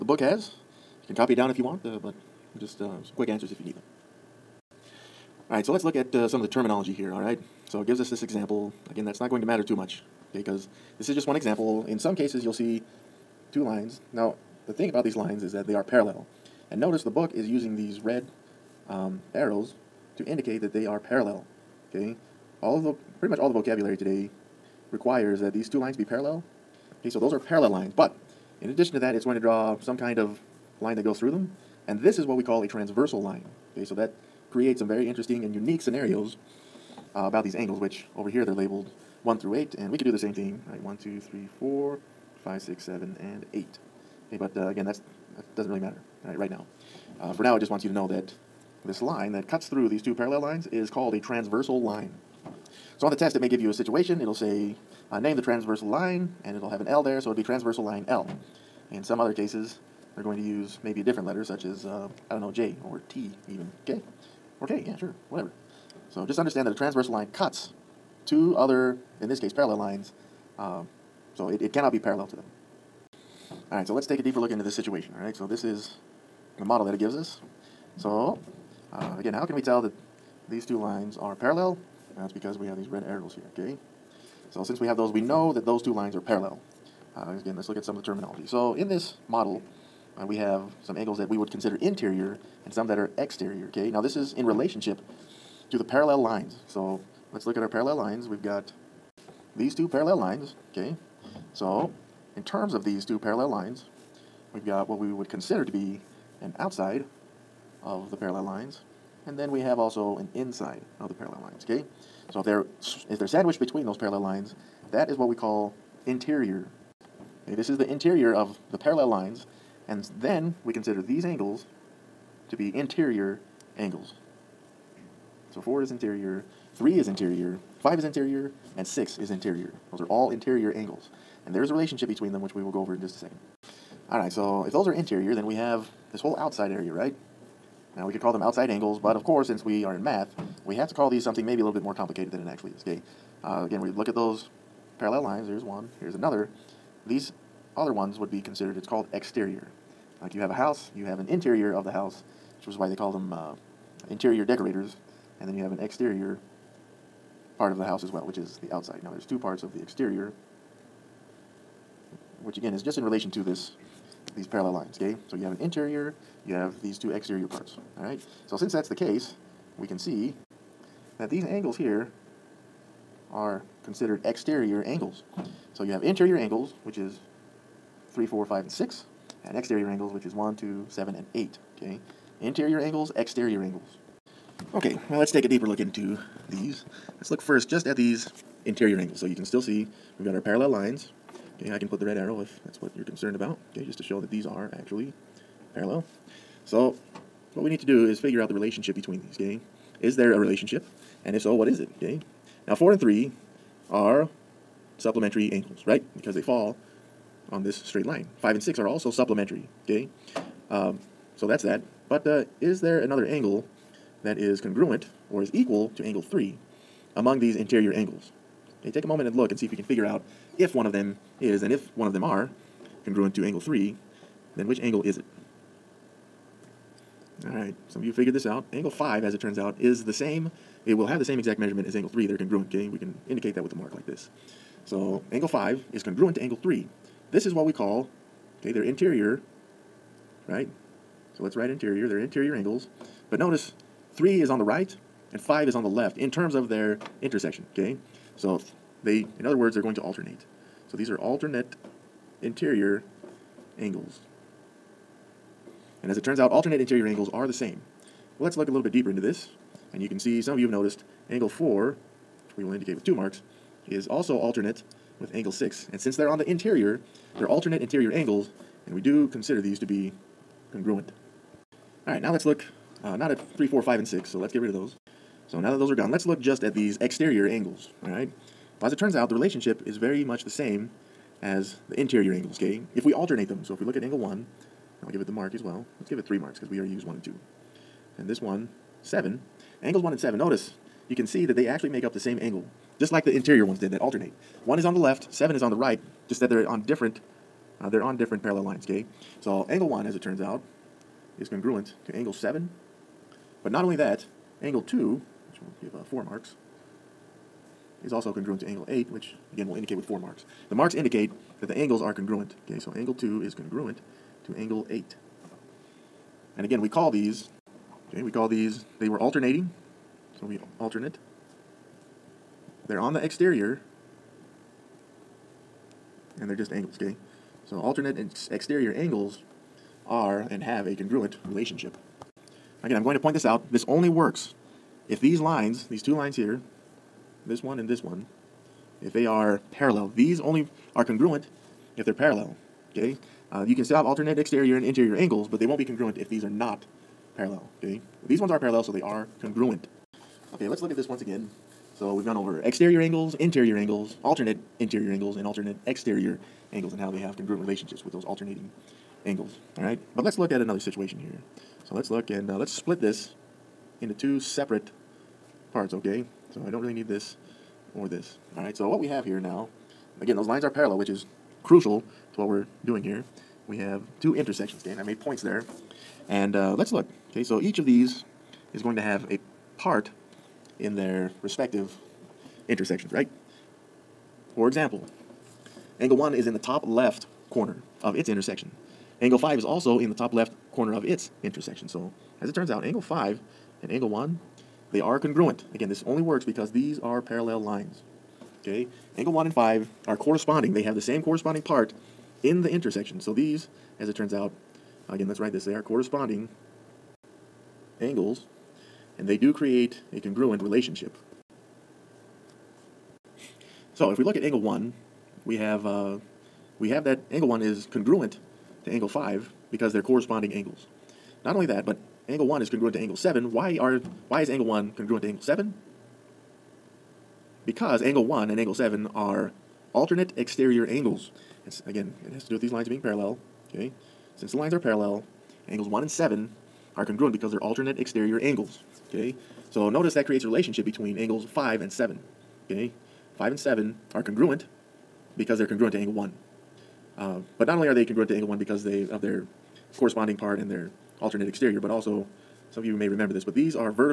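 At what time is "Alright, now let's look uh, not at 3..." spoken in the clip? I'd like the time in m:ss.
4:32.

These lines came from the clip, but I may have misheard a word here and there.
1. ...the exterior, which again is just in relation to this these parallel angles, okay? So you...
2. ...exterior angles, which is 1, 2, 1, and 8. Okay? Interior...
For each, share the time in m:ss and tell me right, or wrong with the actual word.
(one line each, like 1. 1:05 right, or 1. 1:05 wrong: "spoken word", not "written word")
1. 2:39 wrong: "lines", not "angles"
2. 2:59 wrong: "7", not "1".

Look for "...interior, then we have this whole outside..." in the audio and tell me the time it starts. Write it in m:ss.
2:14.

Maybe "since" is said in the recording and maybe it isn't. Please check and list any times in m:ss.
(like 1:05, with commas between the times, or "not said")
1:24, 2:19, 2:48, 4:25, 7:14.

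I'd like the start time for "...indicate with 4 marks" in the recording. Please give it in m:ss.
5:09.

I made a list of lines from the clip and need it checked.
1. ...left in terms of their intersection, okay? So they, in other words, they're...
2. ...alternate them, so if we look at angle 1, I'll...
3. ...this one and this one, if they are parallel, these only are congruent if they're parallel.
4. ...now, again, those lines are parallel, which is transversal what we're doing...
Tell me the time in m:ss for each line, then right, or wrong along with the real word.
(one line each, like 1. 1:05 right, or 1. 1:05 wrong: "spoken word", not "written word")
1. 4:05 right
2. 4:43 right
3. 5:37 right
4. 6:09 wrong: "crucial", not "transversal".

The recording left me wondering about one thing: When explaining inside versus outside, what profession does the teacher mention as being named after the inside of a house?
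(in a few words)
Interior decorators.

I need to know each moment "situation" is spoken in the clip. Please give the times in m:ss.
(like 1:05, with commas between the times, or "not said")
0:53, 1:14, 6:00.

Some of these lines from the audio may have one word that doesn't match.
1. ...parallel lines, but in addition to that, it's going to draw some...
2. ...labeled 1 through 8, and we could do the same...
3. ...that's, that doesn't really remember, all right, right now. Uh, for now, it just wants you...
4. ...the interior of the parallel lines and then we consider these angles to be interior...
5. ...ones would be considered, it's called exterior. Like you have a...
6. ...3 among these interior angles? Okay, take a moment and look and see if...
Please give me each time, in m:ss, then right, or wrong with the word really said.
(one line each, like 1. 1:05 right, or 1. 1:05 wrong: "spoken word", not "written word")
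1. 0:27 right
2. 0:38 right
3. 0:44 wrong: "matter", not "remember"
4. 1:57 right
5. 2:27 right
6. 3:36 right.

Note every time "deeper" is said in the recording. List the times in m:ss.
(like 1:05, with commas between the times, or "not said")
1:14, 3:05, 4:18.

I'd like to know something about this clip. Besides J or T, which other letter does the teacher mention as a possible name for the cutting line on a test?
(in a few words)
K.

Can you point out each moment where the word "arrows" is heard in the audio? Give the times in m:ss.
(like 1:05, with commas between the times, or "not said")
0:19, 1:23, 3:12.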